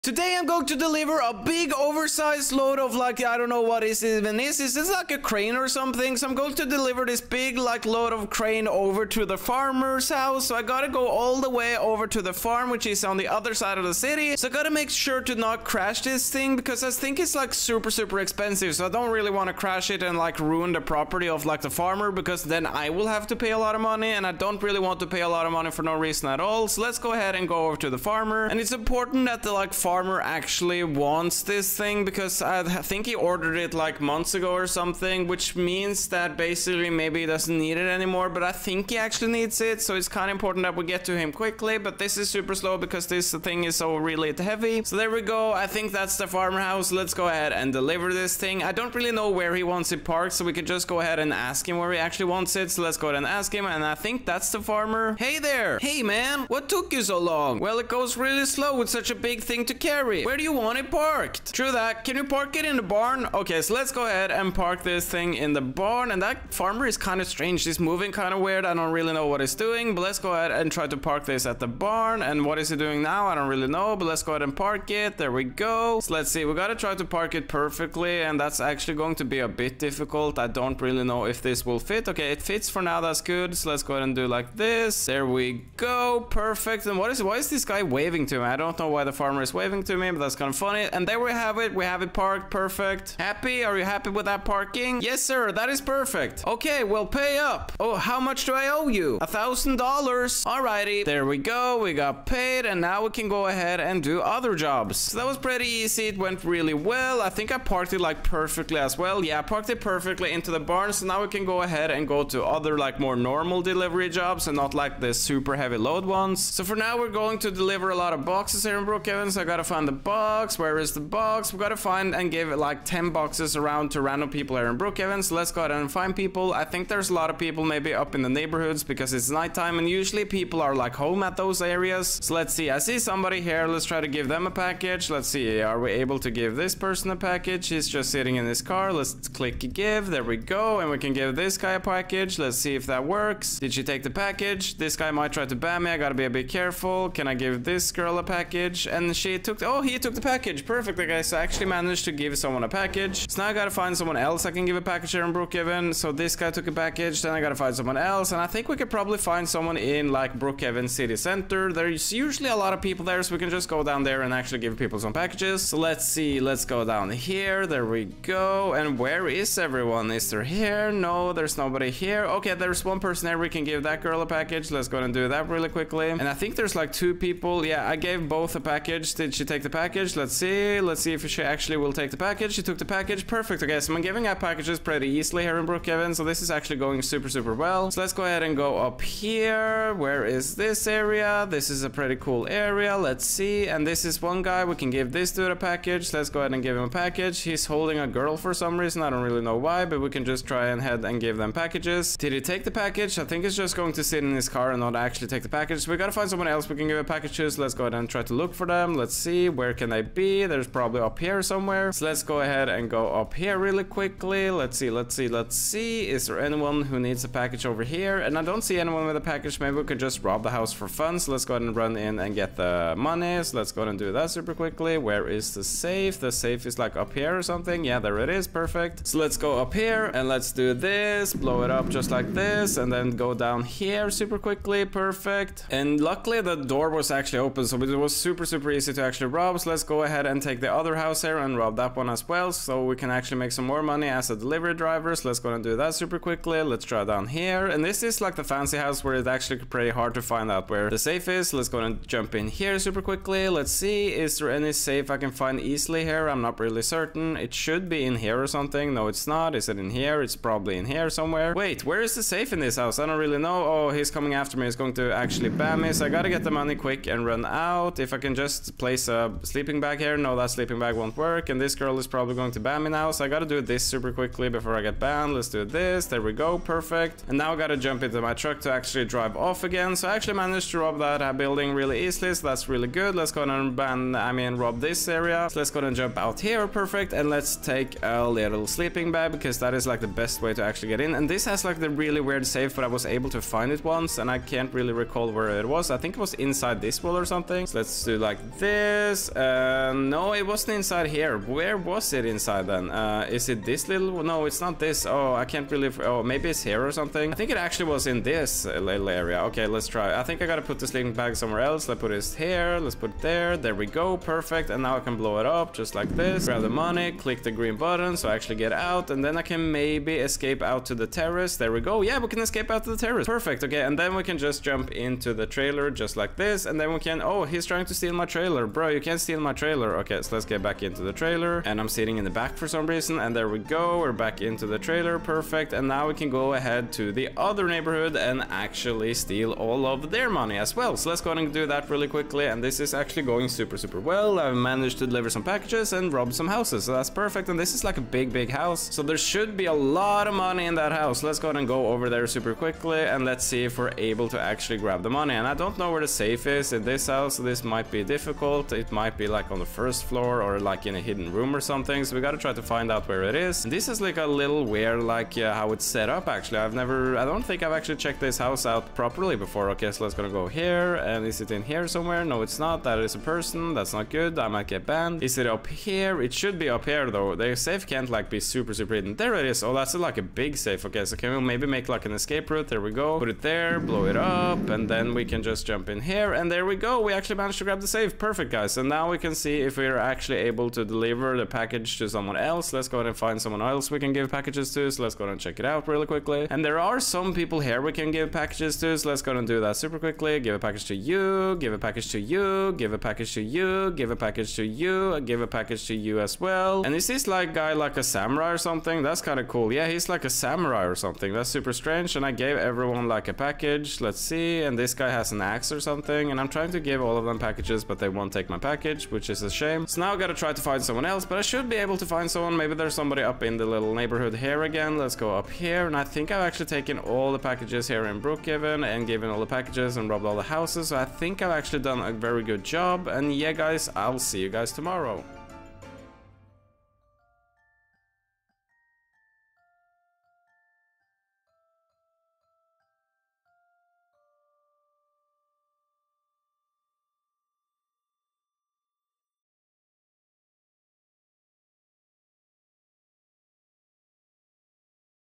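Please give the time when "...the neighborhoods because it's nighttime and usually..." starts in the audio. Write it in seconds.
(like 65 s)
128 s.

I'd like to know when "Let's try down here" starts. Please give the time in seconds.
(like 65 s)
246 s.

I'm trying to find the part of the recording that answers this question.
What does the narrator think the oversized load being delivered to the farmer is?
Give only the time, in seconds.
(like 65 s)
5 s.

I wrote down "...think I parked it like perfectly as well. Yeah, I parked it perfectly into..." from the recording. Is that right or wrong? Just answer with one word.
right.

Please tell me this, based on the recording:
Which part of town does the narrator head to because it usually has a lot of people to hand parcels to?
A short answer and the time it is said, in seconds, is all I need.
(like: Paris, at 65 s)
Brookhaven city center, at 160 s.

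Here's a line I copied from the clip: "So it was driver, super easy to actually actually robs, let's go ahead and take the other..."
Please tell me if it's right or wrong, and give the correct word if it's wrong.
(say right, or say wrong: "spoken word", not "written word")
wrong: "super", not "driver".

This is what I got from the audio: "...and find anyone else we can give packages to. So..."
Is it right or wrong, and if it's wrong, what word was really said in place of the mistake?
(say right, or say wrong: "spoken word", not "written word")
wrong: "someone", not "anyone".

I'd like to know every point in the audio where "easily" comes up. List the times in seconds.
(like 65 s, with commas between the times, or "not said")
185 s, 255 s, 282 s.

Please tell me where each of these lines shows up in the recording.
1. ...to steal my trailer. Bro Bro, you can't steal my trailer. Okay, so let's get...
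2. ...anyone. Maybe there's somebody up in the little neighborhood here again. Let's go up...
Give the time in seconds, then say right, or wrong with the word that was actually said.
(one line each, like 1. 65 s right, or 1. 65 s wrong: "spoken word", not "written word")
1. 327 s right
2. 422 s wrong: "someone", not "anyone".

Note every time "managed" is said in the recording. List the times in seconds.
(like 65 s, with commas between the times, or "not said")
151 s, 280 s, 344 s, 387 s.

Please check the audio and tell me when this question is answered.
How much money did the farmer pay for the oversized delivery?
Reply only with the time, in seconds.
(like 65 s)
99 s.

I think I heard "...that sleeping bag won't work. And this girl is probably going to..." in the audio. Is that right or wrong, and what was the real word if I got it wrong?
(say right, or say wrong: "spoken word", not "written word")
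right.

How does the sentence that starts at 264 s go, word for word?
He's going to actually ban me.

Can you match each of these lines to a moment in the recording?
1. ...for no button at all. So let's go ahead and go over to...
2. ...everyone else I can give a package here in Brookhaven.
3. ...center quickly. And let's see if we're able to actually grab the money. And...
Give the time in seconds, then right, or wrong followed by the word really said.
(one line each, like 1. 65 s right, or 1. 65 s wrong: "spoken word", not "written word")
1. 25 s wrong: "reason", not "button"
2. 153 s wrong: "someone", not "everyone"
3. 352 s wrong: "super", not "center".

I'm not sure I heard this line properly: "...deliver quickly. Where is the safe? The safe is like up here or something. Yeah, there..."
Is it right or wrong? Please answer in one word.
wrong.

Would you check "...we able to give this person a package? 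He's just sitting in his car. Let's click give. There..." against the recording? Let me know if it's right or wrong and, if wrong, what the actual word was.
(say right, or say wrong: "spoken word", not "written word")
right.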